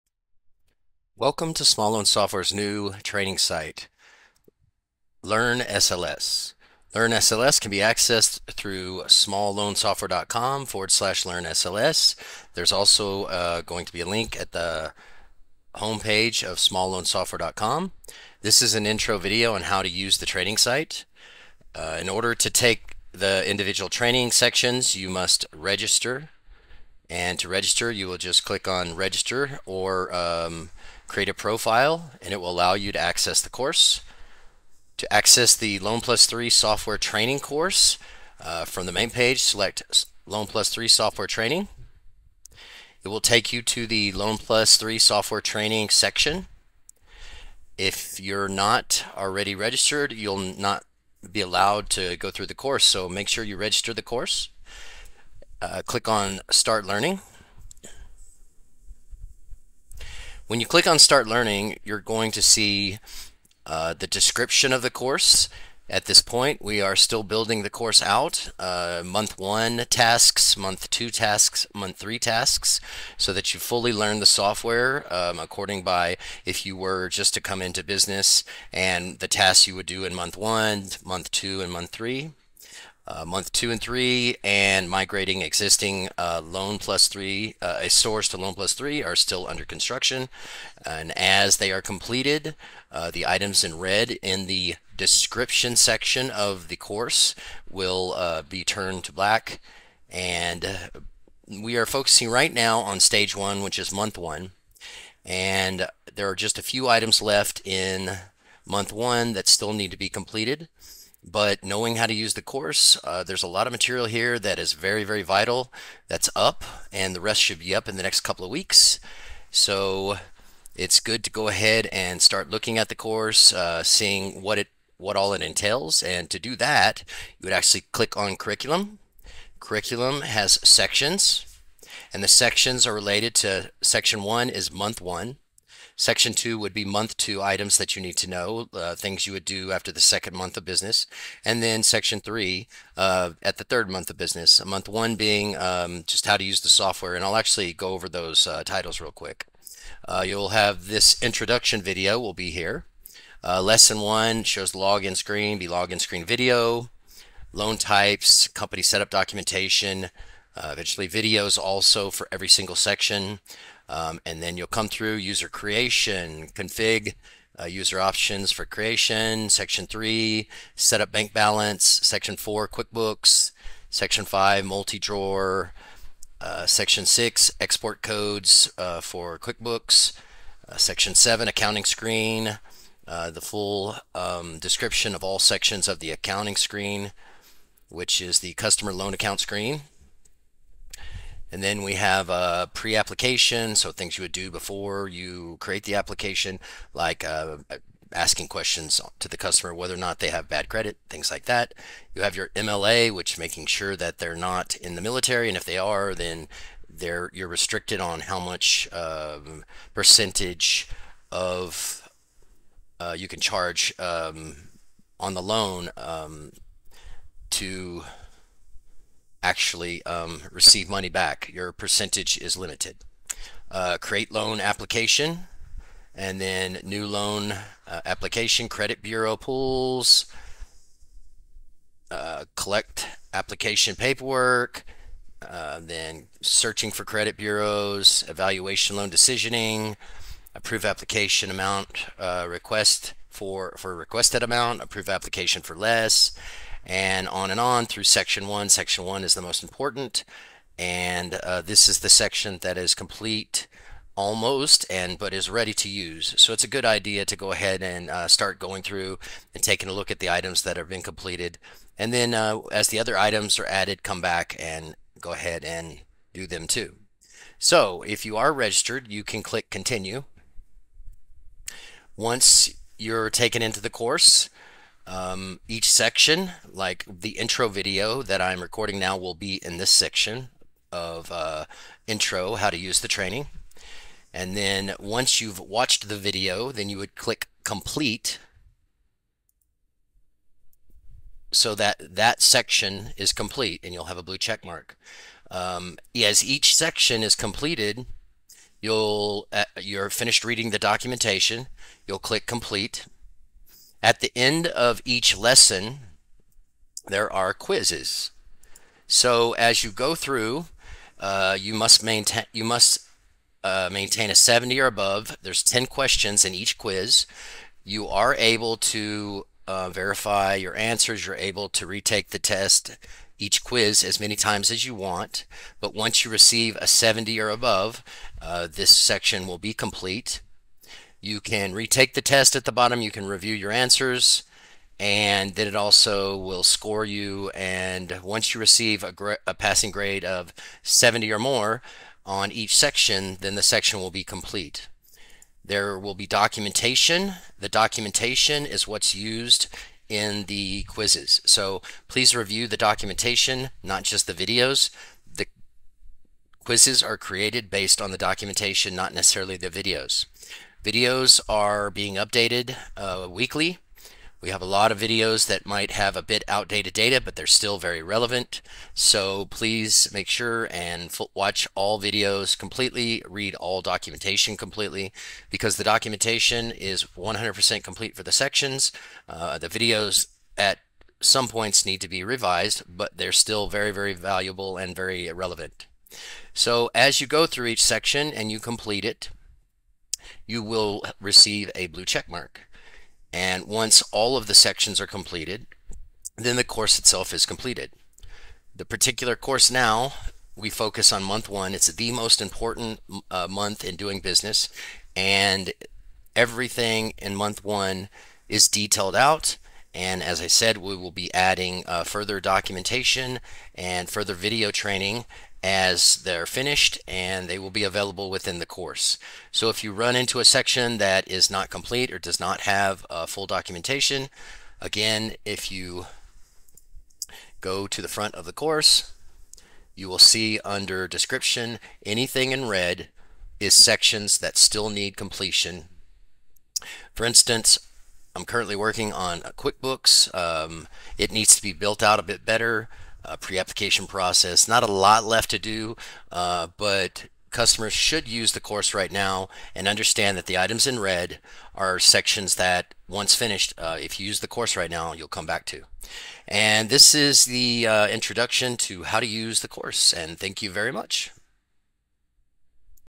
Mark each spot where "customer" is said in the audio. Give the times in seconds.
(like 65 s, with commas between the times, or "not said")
188 s, 199 s, 447 s.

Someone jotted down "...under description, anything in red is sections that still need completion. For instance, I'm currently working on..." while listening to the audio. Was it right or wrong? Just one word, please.
right.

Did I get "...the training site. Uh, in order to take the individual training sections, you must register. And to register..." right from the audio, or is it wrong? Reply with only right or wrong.
right.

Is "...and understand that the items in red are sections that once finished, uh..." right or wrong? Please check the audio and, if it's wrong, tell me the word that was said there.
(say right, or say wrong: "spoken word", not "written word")
right.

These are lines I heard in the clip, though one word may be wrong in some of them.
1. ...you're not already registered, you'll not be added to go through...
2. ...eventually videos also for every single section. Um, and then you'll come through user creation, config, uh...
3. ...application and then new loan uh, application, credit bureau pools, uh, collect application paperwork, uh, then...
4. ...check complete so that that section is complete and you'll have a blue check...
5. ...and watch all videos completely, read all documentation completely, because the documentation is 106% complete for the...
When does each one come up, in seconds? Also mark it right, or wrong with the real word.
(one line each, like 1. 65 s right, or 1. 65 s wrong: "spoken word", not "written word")
1. 48 s wrong: "allowed", not "added"
2. 160 s right
3. 224 s right
4. 287 s wrong: "click", not "check"
5. 370 s wrong: "100", not "106".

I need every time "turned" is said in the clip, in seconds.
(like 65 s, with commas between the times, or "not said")
98 s.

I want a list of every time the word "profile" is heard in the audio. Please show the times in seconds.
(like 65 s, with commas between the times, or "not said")
31 s.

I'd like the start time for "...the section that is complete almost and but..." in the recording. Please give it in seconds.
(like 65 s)
251 s.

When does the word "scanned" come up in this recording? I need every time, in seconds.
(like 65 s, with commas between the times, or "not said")
not said.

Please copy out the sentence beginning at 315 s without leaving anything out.
There's 10 questions in each quiz.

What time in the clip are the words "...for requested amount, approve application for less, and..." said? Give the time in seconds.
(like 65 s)
243 s.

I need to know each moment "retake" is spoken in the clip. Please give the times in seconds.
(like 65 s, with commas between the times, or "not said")
321 s, 331 s.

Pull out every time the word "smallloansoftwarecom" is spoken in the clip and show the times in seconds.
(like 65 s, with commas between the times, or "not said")
9 s, 16 s.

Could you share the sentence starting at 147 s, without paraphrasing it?
And I'll actually go over those uh, titles real quick.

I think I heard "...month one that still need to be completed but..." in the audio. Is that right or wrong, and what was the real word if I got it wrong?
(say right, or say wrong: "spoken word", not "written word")
right.